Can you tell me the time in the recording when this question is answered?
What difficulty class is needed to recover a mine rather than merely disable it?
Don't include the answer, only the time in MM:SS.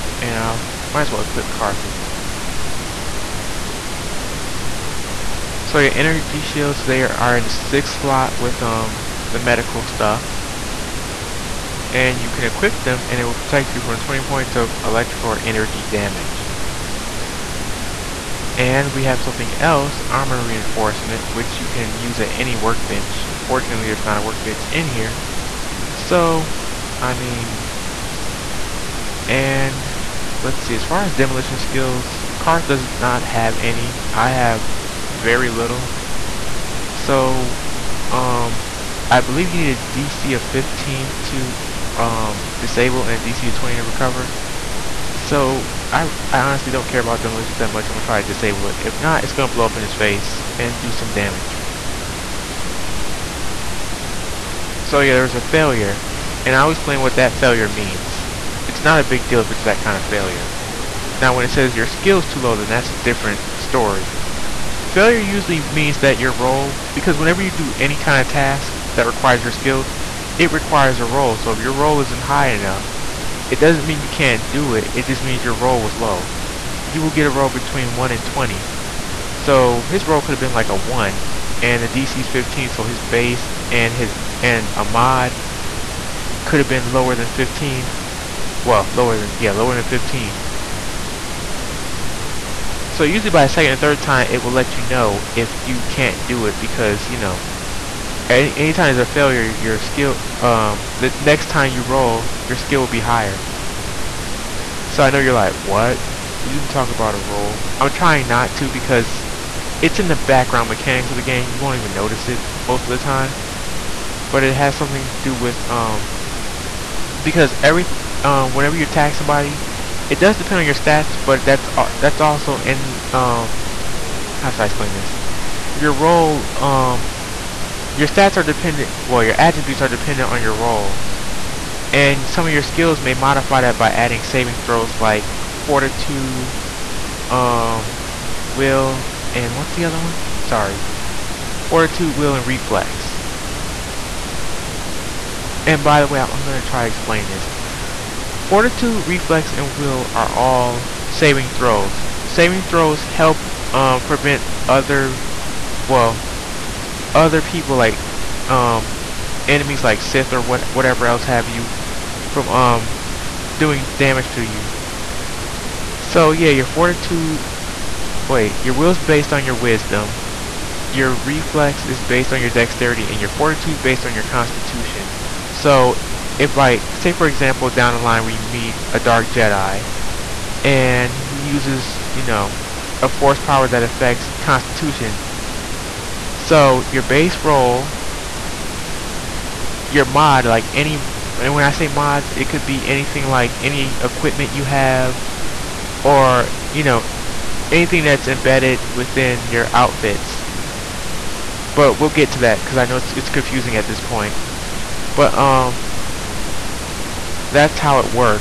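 00:43.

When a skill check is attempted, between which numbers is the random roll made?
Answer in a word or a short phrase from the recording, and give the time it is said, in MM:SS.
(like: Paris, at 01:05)
1 and 20, at 01:17.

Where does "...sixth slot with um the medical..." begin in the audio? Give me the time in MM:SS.
00:07.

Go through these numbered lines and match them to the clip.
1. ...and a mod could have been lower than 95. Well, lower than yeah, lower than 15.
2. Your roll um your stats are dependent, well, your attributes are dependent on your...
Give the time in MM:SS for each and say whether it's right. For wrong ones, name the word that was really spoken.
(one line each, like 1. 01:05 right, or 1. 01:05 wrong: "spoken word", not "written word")
1. 01:24 wrong: "15", not "95"
2. 02:05 right.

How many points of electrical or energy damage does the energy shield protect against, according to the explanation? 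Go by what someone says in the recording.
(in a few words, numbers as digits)
20.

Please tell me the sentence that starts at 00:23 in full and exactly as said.
Unfortunately, there's not a workbench in here.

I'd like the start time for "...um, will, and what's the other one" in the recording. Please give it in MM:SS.
02:17.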